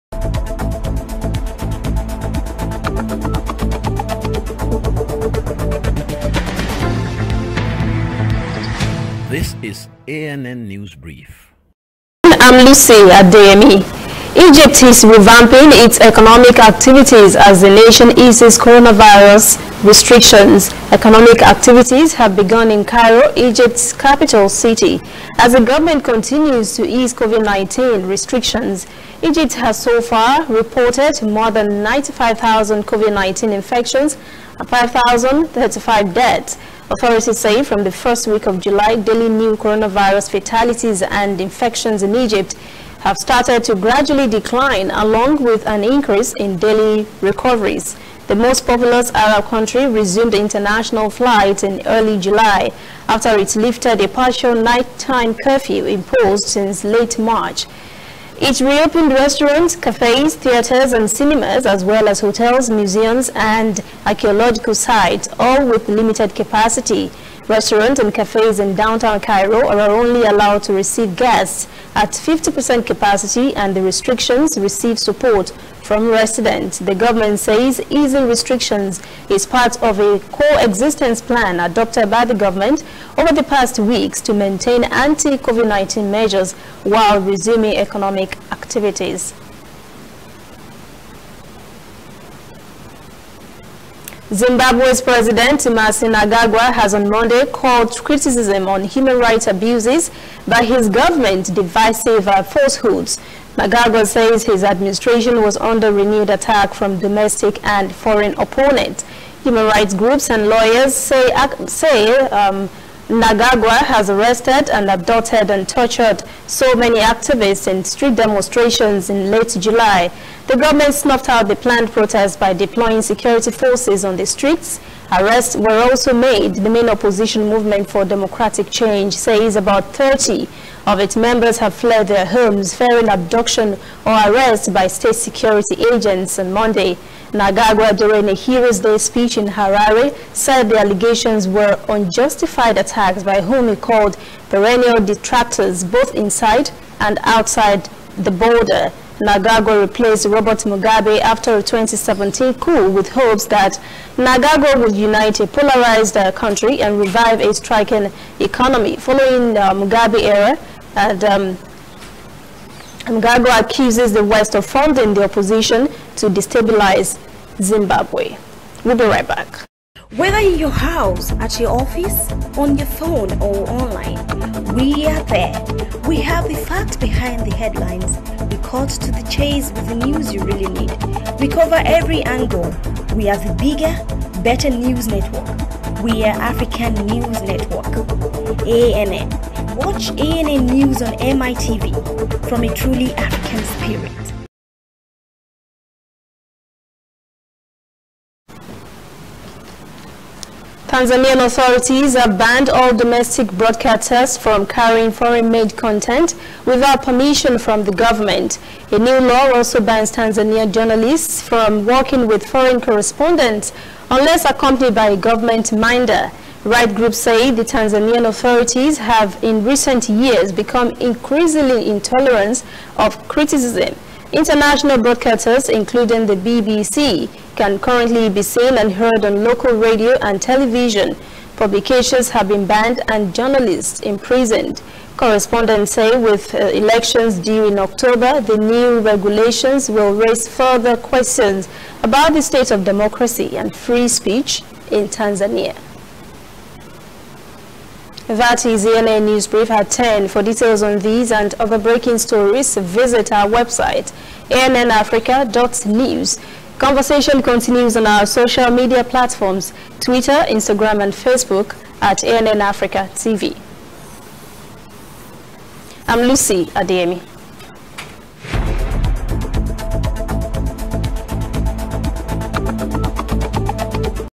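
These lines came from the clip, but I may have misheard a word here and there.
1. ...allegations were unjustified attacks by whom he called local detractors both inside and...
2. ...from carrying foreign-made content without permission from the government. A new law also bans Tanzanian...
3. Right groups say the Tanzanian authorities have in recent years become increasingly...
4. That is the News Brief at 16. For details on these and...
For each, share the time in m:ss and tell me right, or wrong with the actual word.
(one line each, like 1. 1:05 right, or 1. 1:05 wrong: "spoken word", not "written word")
1. 2:20 wrong: "perennial", not "local"
2. 3:24 right
3. 3:36 right
4. 4:08 wrong: "10", not "16".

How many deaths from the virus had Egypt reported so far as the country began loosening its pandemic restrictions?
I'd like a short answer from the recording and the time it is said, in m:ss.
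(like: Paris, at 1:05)
5,035, at 0:34.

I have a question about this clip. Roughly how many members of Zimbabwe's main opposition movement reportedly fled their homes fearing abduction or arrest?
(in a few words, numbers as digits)
30.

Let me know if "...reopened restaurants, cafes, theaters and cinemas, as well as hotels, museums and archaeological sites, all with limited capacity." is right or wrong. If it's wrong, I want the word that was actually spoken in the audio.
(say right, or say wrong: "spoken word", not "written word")
right.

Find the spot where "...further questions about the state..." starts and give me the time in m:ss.
4:00.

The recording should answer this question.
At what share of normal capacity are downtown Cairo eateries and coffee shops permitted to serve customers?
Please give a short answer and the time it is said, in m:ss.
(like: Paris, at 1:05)
50%, at 1:12.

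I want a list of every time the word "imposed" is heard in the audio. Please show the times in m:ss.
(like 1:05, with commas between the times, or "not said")
0:55.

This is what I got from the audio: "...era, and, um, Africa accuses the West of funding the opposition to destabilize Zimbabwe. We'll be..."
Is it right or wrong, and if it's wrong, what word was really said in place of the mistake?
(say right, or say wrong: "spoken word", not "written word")
wrong: "Mugabe", not "Africa".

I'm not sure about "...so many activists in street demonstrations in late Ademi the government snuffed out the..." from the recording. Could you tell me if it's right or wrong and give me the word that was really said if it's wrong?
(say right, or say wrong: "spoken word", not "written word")
wrong: "July", not "Ademi".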